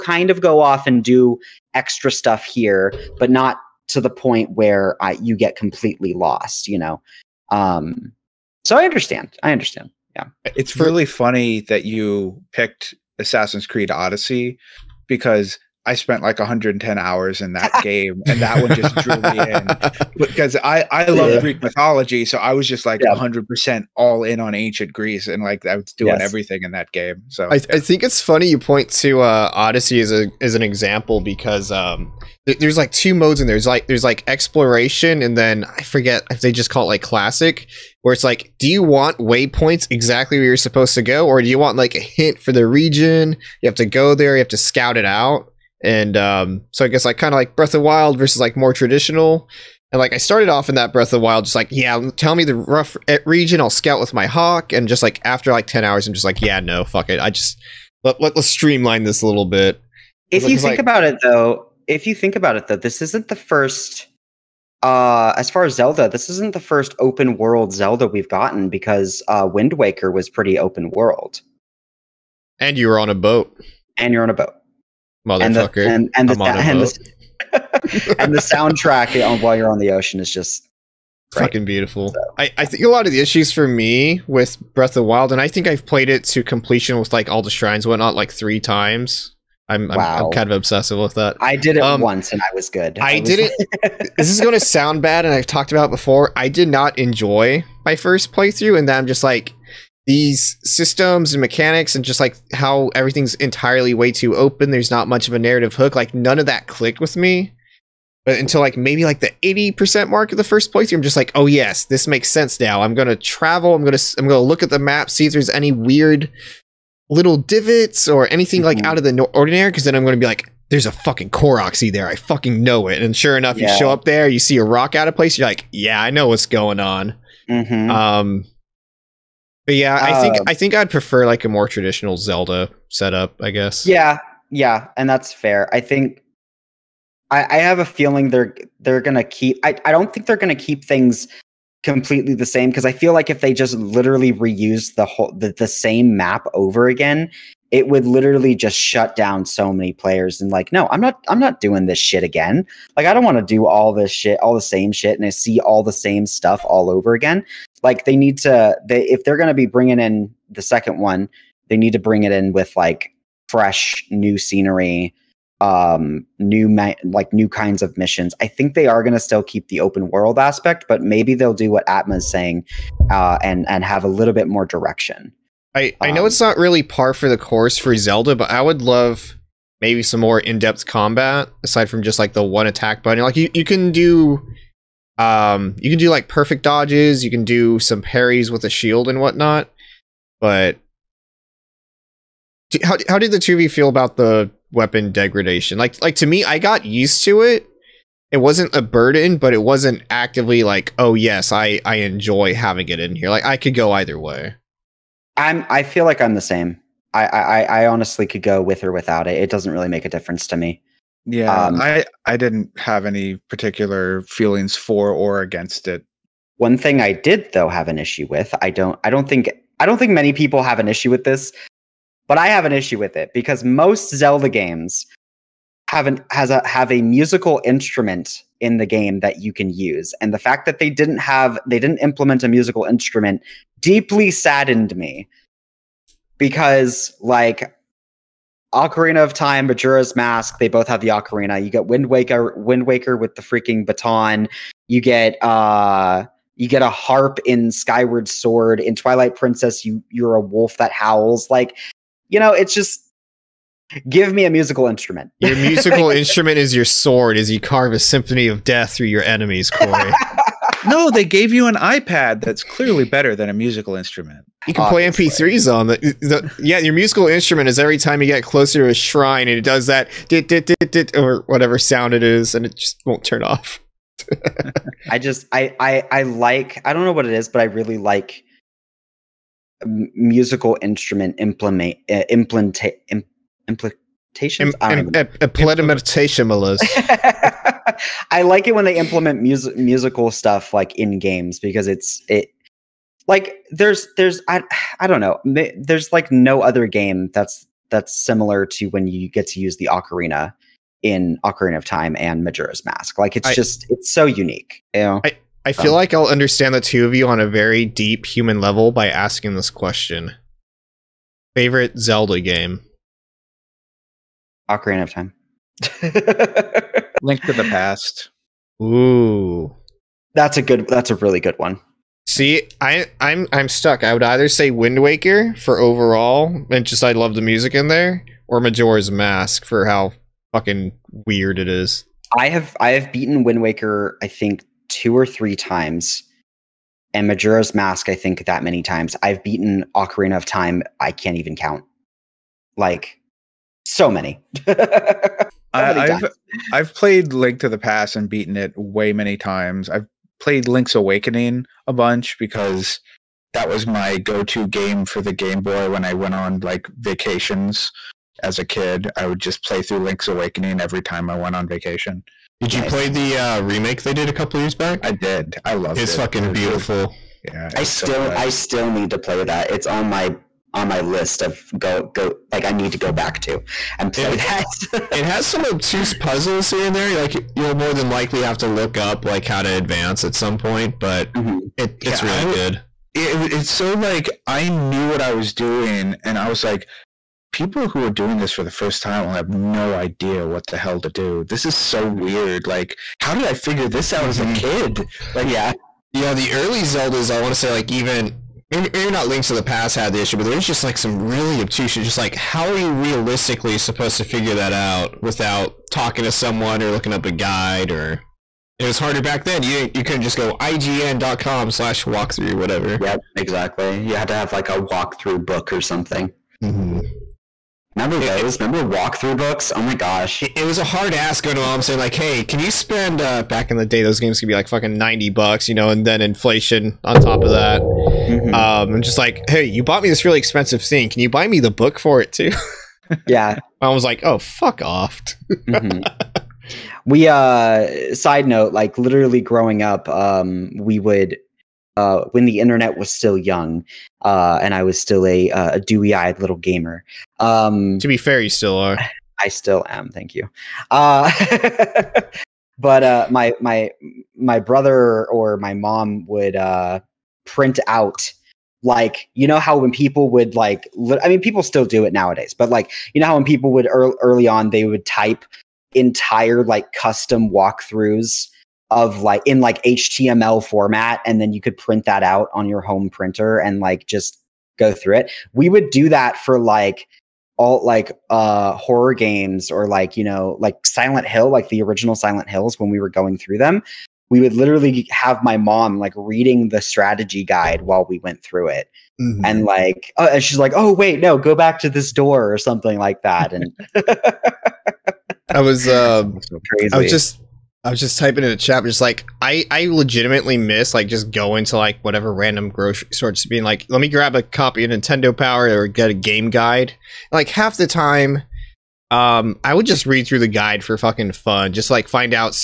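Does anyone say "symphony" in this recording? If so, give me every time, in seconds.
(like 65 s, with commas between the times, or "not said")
257 s.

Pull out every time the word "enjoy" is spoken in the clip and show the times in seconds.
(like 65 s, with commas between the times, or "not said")
96 s, 201 s.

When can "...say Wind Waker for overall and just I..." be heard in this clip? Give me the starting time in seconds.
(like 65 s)
324 s.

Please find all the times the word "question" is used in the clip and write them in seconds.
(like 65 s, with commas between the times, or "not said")
309 s.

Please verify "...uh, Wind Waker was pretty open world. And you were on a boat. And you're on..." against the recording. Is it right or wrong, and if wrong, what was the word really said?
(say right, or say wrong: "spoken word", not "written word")
right.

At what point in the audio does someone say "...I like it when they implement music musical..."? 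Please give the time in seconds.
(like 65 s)
288 s.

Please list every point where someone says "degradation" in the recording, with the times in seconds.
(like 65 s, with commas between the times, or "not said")
195 s.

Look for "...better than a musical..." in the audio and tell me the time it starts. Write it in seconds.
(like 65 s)
263 s.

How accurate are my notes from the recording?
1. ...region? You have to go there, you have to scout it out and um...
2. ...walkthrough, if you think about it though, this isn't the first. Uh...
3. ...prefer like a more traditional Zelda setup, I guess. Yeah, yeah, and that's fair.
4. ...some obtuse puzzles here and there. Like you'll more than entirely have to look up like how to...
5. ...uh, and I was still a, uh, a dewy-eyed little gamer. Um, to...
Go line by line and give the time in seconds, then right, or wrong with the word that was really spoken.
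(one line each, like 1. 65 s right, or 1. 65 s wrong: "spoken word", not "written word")
1. 42 s right
2. 61 s wrong: "though", not "walkthrough"
3. 130 s right
4. 375 s wrong: "likely", not "entirely"
5. 444 s right.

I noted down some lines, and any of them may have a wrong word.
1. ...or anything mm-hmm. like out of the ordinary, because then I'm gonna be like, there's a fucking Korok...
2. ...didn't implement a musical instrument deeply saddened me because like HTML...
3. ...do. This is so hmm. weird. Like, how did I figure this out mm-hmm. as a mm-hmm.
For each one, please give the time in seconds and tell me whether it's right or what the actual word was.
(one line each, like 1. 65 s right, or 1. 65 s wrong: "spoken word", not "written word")
1. 118 s right
2. 231 s wrong: "Ocarina", not "HTML"
3. 391 s right.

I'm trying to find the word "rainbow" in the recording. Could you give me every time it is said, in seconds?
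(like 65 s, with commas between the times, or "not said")
not said.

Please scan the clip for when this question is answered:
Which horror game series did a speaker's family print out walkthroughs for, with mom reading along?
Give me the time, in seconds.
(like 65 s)
480 s.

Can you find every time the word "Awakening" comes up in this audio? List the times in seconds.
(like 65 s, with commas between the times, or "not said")
350 s, 360 s.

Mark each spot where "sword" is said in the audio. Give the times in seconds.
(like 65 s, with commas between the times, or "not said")
248 s, 256 s.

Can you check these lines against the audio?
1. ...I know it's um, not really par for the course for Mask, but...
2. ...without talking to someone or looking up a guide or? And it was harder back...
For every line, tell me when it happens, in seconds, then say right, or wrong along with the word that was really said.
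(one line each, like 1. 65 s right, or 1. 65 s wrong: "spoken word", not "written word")
1. 176 s wrong: "Zelda", not "Mask"
2. 405 s right.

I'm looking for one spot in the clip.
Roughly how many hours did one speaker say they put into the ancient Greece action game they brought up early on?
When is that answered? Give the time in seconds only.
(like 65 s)
16 s.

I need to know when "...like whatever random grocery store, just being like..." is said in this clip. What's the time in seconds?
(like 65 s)
501 s.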